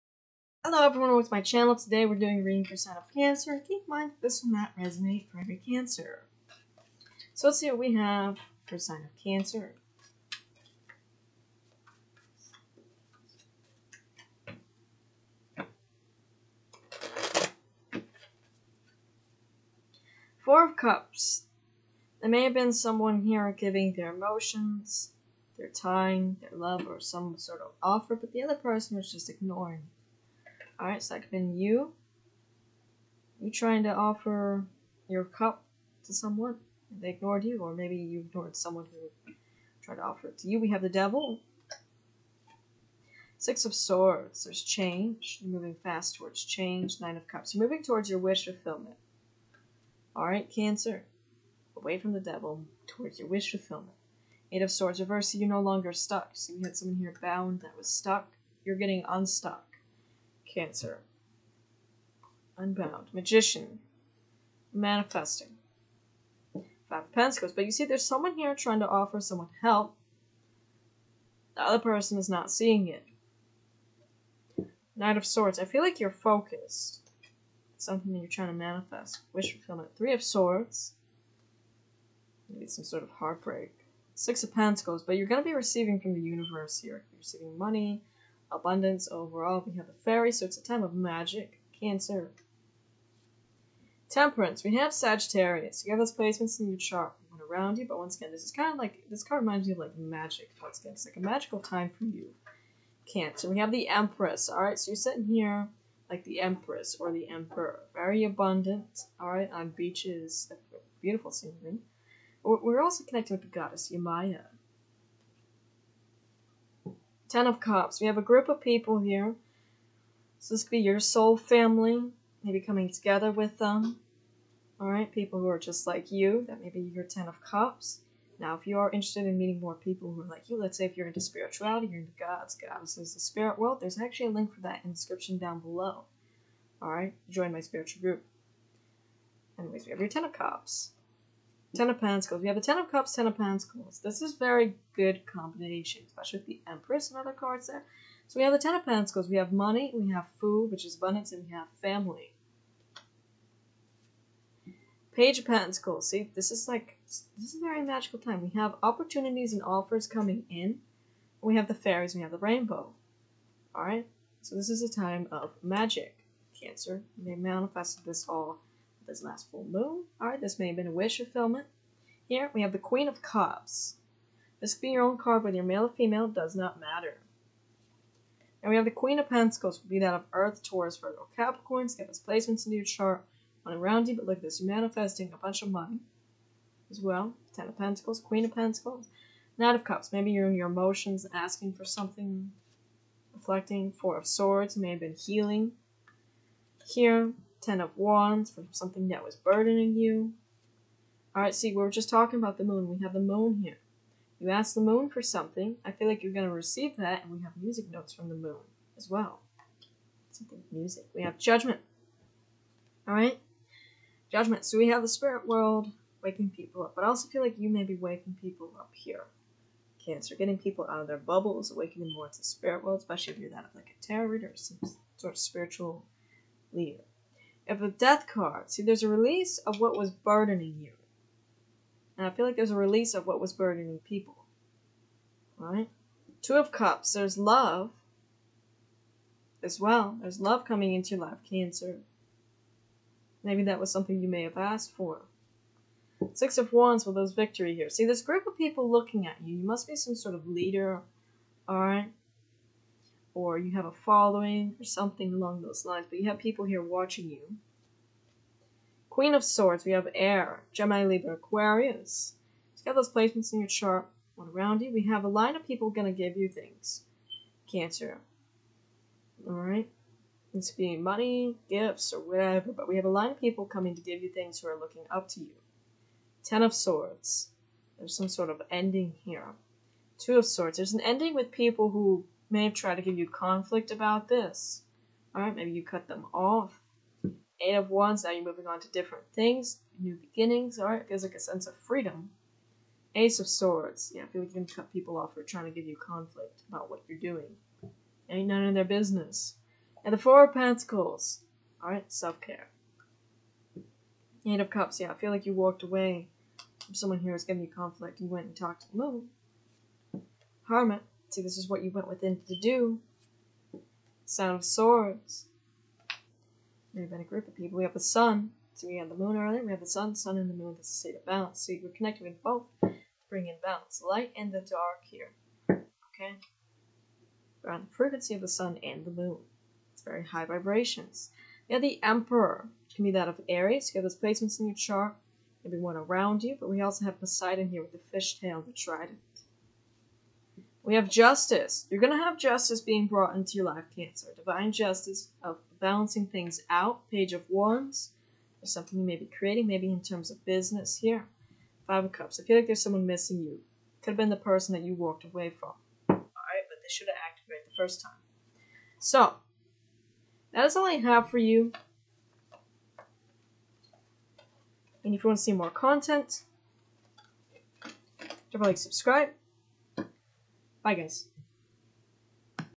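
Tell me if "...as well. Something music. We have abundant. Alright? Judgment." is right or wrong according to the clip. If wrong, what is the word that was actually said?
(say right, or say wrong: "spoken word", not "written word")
wrong: "judgment", not "abundant".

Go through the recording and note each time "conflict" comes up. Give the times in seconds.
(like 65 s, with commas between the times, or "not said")
283 s, 295 s, 307 s.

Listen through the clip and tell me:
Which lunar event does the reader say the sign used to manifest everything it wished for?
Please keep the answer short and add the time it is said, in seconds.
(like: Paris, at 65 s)
last full moon, at 169 s.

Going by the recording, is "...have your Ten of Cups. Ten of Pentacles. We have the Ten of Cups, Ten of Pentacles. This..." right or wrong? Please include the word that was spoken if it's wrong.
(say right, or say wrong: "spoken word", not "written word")
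right.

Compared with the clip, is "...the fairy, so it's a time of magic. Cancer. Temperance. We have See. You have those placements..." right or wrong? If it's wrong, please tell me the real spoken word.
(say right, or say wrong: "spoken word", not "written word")
wrong: "Sagittarius", not "See".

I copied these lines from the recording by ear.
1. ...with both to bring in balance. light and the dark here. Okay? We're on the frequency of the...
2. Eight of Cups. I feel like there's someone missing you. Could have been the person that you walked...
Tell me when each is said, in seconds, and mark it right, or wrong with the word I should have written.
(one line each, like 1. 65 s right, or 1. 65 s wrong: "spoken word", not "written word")
1. 322 s right
2. 351 s wrong: "Five", not "Eight".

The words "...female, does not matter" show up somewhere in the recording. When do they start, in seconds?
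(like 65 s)
175 s.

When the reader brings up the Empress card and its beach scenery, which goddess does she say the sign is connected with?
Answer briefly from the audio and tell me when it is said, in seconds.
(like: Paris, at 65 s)
Yemaya, at 113 s.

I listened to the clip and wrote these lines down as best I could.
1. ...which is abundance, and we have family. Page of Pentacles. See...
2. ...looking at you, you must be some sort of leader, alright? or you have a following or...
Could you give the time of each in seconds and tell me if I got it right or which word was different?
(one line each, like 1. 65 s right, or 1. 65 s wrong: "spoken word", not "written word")
1. 150 s right
2. 248 s right.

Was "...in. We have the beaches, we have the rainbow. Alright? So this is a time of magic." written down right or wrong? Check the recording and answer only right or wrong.
wrong.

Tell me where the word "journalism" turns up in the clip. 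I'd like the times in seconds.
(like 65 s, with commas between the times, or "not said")
not said.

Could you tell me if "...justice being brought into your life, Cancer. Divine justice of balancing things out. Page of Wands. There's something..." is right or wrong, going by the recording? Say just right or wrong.
right.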